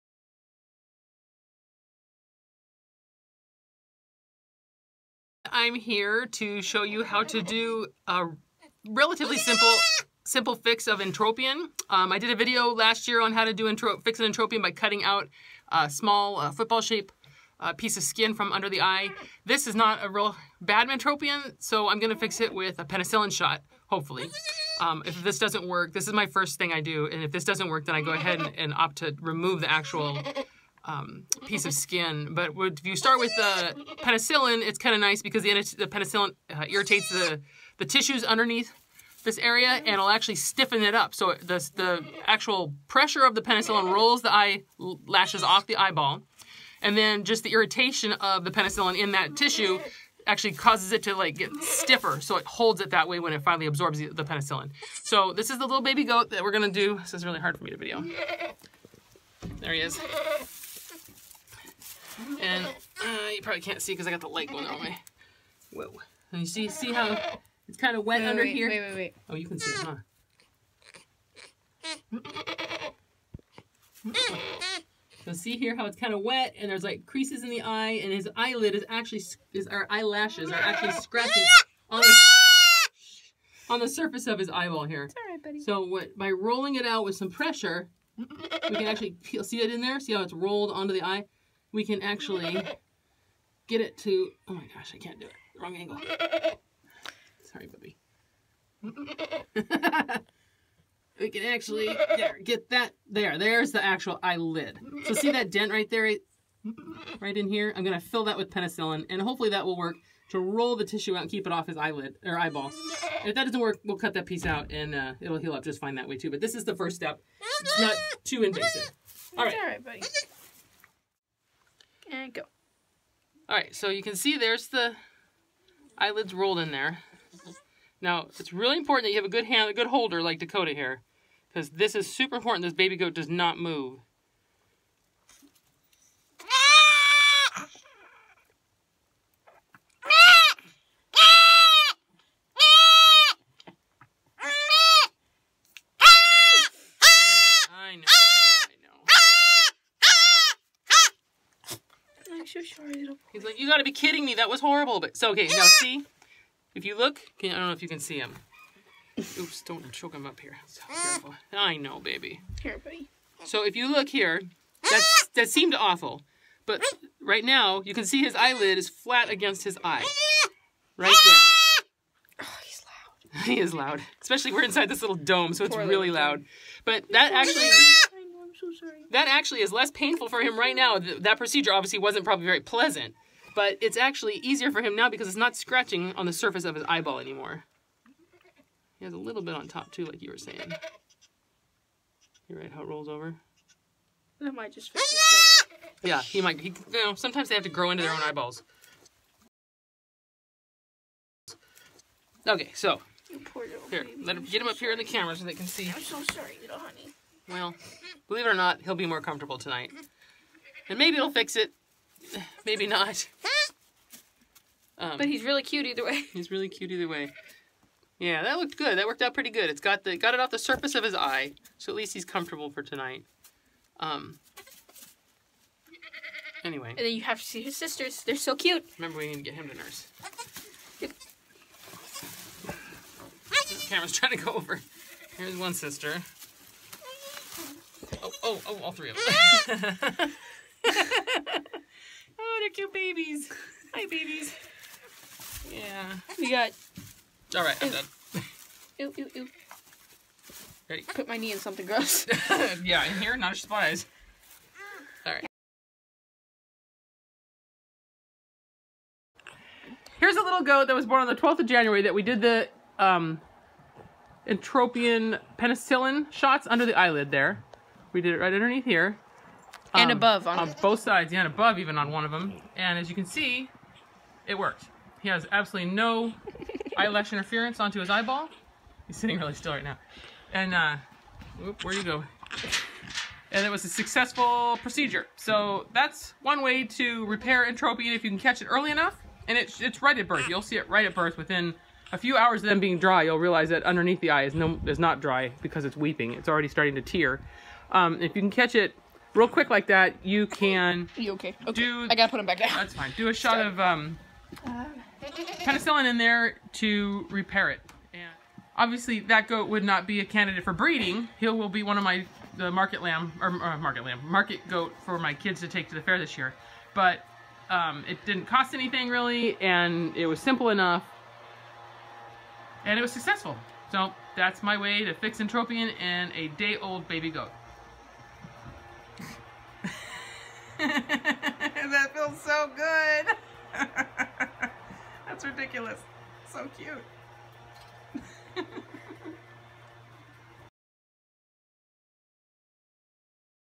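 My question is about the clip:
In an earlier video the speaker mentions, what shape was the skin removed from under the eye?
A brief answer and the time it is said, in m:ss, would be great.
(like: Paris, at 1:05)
Football shape, at 0:16.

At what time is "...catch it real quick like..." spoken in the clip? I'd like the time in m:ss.
4:58.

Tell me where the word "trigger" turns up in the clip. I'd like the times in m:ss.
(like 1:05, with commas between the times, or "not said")
not said.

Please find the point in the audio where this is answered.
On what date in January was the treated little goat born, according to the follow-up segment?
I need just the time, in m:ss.
4:21.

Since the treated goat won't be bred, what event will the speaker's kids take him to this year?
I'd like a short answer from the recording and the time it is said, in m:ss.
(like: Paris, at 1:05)
The fair, at 5:15.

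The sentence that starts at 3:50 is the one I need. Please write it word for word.
the camera's trying to go over.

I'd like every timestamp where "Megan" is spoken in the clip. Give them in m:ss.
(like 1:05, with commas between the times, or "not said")
not said.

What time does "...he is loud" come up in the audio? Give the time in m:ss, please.
2:53.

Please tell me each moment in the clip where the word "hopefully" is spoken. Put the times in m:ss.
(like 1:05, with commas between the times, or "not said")
0:23, 1:49.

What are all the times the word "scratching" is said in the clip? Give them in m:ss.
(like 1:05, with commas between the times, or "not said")
1:20, 3:05.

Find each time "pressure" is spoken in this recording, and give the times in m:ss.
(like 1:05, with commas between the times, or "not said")
0:42, 1:27.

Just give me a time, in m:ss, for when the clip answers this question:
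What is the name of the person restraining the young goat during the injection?
2:10.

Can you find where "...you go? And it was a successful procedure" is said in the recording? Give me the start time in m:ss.
4:41.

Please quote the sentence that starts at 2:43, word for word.
So if you look here, that that seemed awful.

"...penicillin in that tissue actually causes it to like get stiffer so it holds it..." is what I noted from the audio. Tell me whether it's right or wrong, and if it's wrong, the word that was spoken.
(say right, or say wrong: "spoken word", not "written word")
right.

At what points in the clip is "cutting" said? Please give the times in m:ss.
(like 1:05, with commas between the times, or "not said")
0:14.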